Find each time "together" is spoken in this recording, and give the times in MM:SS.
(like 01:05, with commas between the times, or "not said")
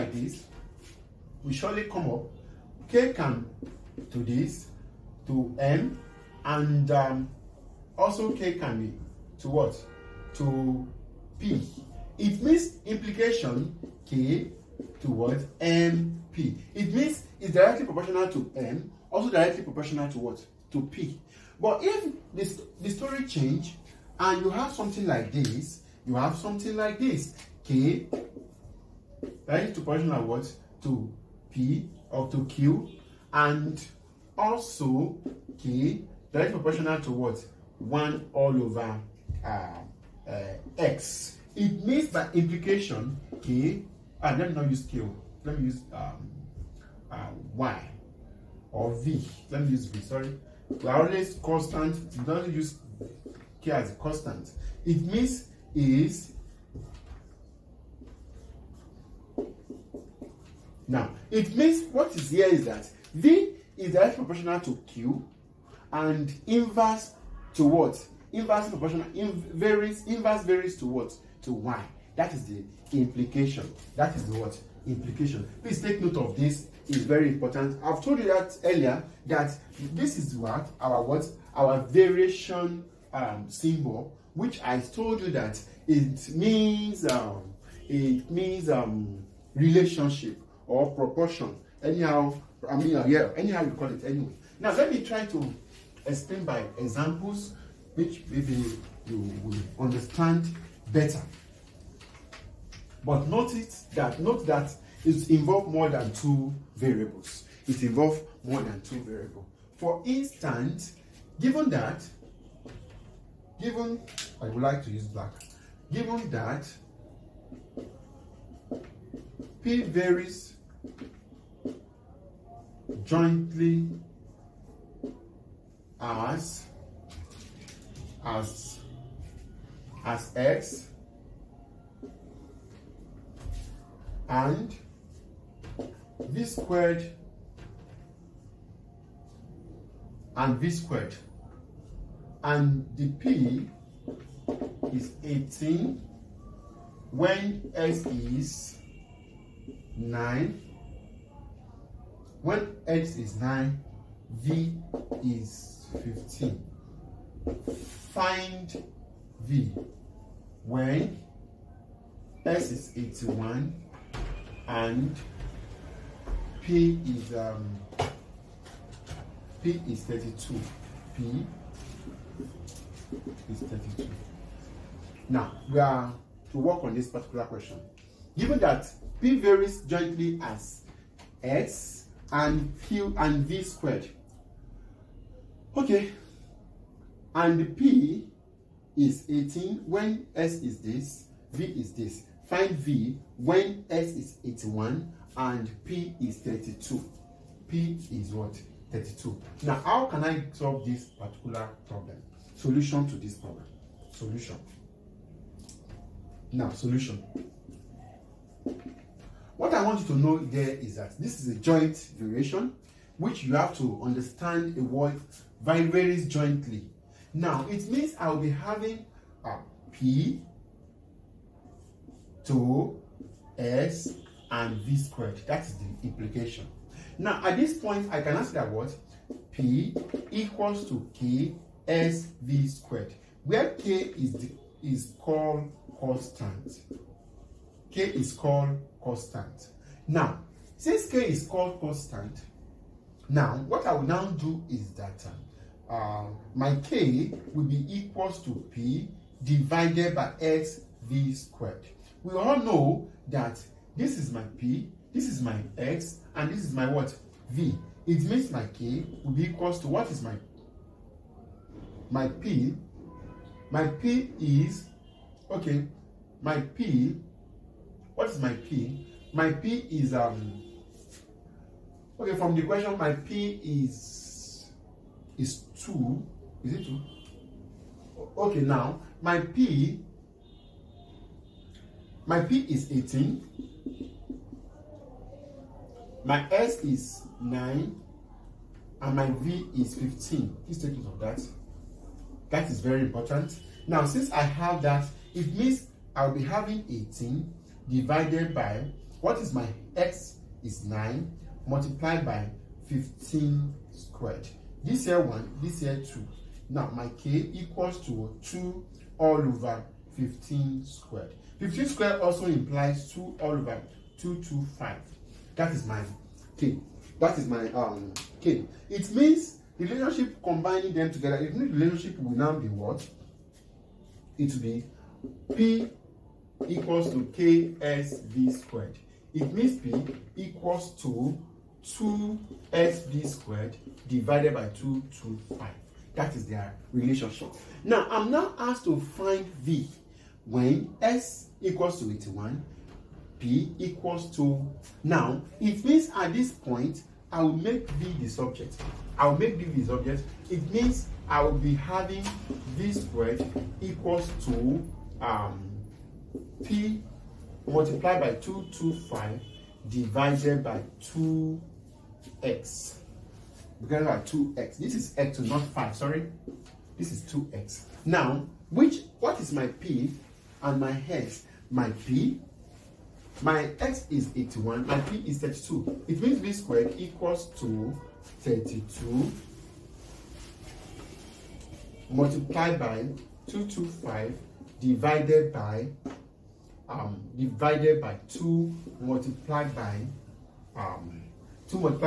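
05:21.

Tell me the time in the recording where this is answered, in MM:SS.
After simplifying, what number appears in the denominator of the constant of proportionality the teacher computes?
05:13.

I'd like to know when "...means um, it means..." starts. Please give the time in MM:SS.
01:26.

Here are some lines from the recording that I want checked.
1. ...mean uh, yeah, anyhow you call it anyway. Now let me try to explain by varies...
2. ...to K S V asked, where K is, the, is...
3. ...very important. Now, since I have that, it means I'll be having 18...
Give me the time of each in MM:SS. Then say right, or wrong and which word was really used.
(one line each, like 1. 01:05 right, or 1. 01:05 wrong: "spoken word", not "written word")
1. 01:32 wrong: "examples", not "varies"
2. 03:50 wrong: "squared", not "asked"
3. 04:52 right.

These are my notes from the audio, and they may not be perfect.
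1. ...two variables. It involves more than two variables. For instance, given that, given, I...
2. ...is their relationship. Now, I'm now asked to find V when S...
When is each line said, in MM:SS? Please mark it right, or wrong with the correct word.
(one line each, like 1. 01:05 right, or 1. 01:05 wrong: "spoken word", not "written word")
1. 01:46 right
2. 05:36 right.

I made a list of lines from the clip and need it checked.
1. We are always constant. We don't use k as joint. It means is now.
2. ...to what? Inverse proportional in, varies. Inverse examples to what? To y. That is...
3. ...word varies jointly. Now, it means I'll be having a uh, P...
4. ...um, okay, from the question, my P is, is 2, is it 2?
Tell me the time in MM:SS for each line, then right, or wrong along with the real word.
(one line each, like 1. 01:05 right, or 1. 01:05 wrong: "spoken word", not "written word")
1. 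00:50 wrong: "constant", not "joint"
2. 01:07 wrong: "varies", not "examples"
3. 03:34 right
4. 04:30 right.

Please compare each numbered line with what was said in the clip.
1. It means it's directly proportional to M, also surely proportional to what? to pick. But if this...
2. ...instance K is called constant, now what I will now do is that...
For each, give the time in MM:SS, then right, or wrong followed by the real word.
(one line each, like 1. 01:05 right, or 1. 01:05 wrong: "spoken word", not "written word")
1. 00:16 wrong: "directly", not "surely"
2. 04:00 wrong: "since", not "instance".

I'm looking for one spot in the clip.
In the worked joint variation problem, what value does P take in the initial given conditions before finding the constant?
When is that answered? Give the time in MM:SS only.
04:42.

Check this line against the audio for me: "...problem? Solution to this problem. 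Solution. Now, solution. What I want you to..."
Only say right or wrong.
right.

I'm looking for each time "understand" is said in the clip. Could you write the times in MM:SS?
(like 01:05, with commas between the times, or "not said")
01:39, 03:34.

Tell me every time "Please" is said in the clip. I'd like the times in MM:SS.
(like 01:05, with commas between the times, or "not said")
01:15, 04:50.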